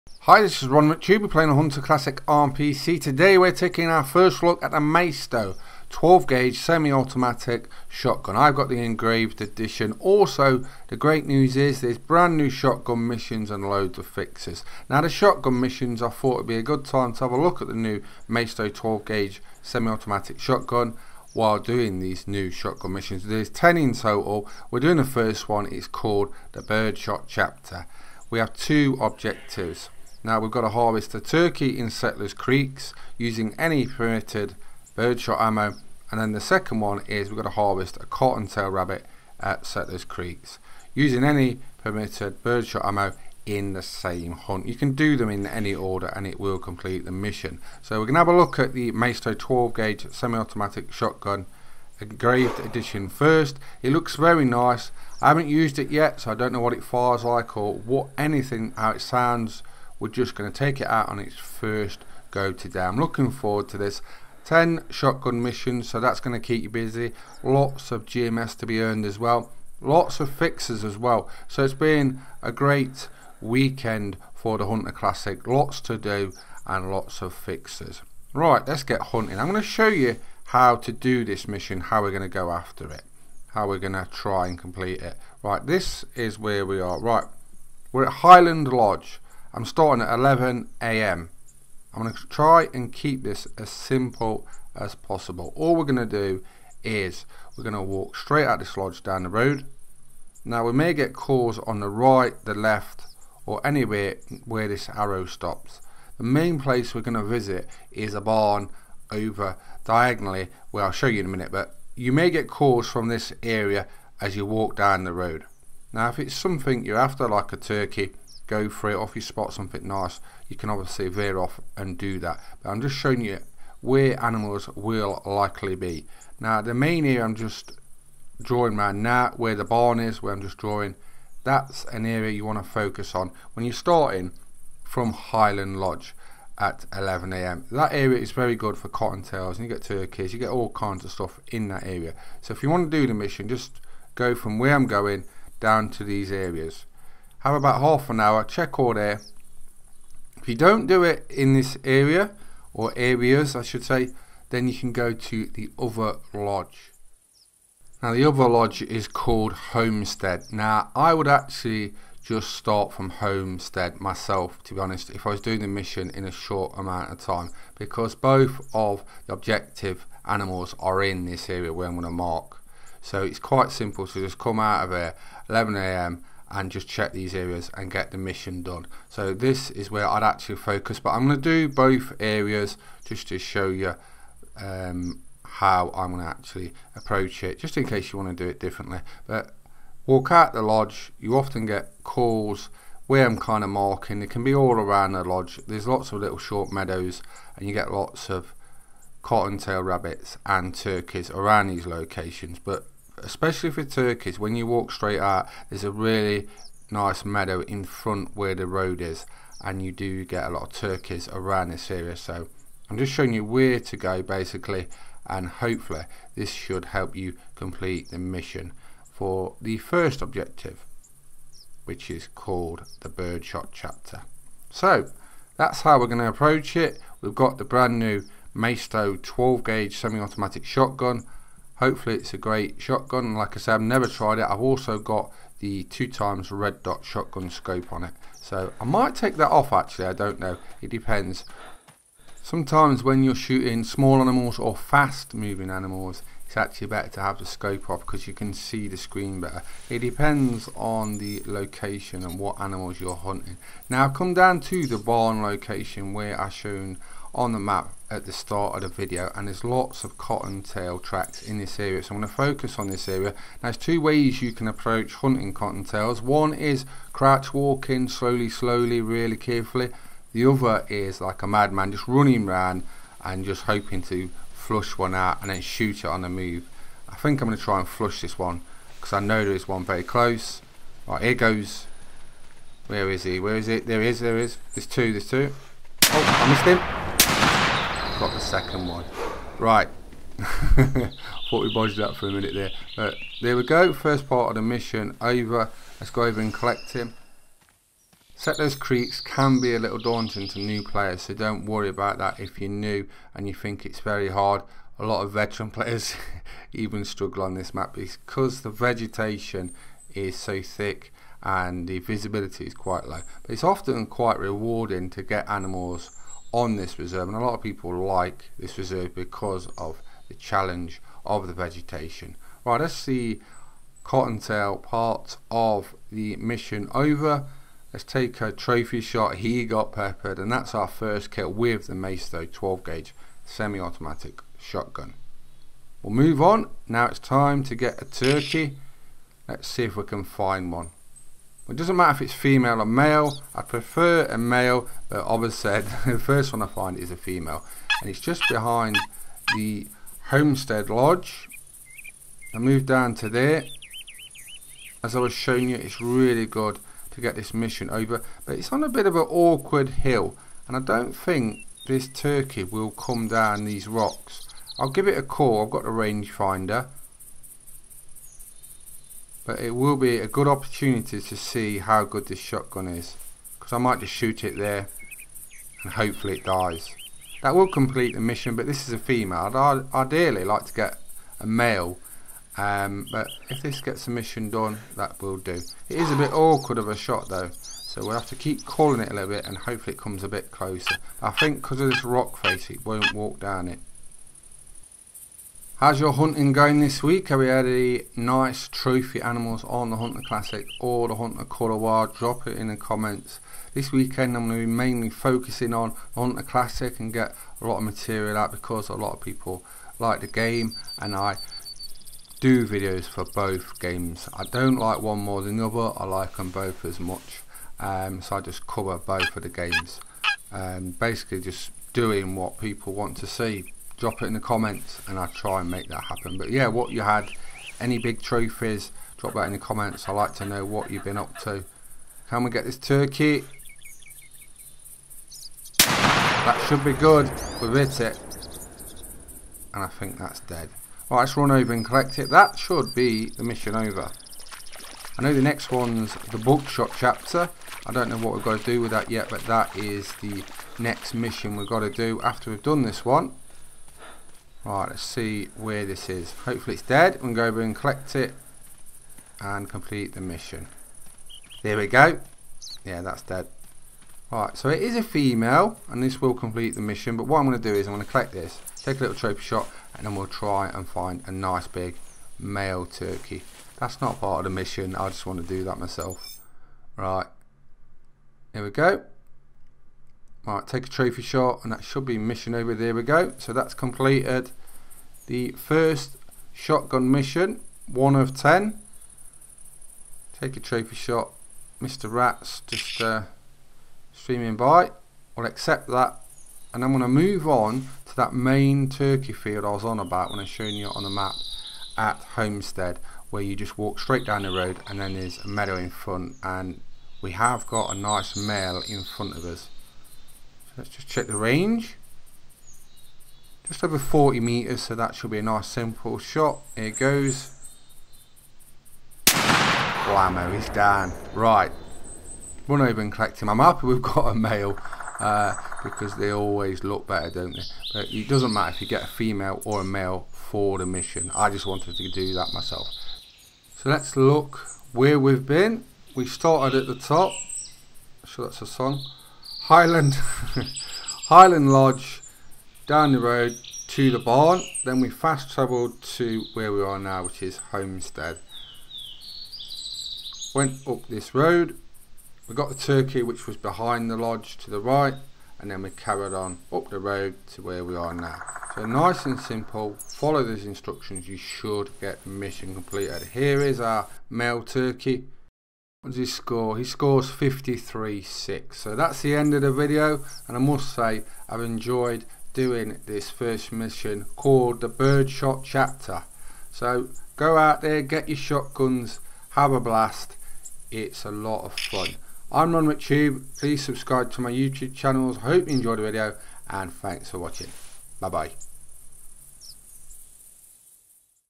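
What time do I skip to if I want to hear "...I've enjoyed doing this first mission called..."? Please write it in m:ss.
9:31.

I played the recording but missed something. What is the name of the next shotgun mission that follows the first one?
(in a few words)
Buckshot chapter.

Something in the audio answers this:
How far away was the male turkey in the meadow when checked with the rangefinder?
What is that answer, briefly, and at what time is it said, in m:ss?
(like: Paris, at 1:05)
just over 40 meters, at 8:33.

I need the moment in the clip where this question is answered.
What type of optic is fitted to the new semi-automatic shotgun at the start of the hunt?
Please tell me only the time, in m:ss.
3:55.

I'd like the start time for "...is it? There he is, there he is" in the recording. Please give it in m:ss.
4:43.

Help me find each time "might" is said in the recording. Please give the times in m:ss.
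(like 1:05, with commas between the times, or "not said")
3:58, 6:13.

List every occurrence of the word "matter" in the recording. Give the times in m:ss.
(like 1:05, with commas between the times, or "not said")
5:41, 8:48.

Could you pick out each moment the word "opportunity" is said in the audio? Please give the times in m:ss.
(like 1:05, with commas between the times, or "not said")
6:10.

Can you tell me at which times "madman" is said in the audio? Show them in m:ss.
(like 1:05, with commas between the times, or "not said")
4:31.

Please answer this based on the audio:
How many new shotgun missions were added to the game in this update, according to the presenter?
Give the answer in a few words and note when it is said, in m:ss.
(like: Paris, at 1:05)
10, at 0:23.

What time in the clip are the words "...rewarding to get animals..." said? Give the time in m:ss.
5:14.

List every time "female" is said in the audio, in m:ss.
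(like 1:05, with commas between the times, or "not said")
5:42, 5:47, 6:18, 7:45, 8:49.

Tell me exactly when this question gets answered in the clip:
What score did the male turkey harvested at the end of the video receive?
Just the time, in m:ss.
9:27.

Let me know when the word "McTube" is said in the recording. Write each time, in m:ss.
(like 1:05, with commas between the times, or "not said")
0:00, 9:42.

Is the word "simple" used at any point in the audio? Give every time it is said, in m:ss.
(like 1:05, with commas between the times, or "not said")
1:33, 2:53, 8:35, 9:19.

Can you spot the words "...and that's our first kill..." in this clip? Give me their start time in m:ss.
5:30.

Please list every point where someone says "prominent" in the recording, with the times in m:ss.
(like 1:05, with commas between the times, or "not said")
not said.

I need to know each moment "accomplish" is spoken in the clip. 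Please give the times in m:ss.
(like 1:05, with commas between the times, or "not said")
not said.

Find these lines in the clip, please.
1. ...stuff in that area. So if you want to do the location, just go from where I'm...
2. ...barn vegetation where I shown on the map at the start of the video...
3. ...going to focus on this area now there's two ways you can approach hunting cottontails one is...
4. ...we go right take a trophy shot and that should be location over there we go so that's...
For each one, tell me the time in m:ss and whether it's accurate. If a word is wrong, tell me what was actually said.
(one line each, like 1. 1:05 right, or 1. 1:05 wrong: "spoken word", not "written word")
1. 2:21 wrong: "mission", not "location"
2. 4:14 wrong: "location", not "vegetation"
3. 4:22 right
4. 7:58 wrong: "mission", not "location".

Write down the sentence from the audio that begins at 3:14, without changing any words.
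It can be all around the lodge.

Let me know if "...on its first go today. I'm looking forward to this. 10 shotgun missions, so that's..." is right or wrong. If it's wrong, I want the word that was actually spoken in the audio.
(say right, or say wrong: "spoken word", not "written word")
right.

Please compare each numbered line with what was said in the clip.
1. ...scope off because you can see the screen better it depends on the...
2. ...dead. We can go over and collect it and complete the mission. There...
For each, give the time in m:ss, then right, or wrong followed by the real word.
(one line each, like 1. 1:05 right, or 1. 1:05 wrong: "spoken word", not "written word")
1. 4:07 right
2. 7:36 right.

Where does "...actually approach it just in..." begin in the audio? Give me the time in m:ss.
3:06.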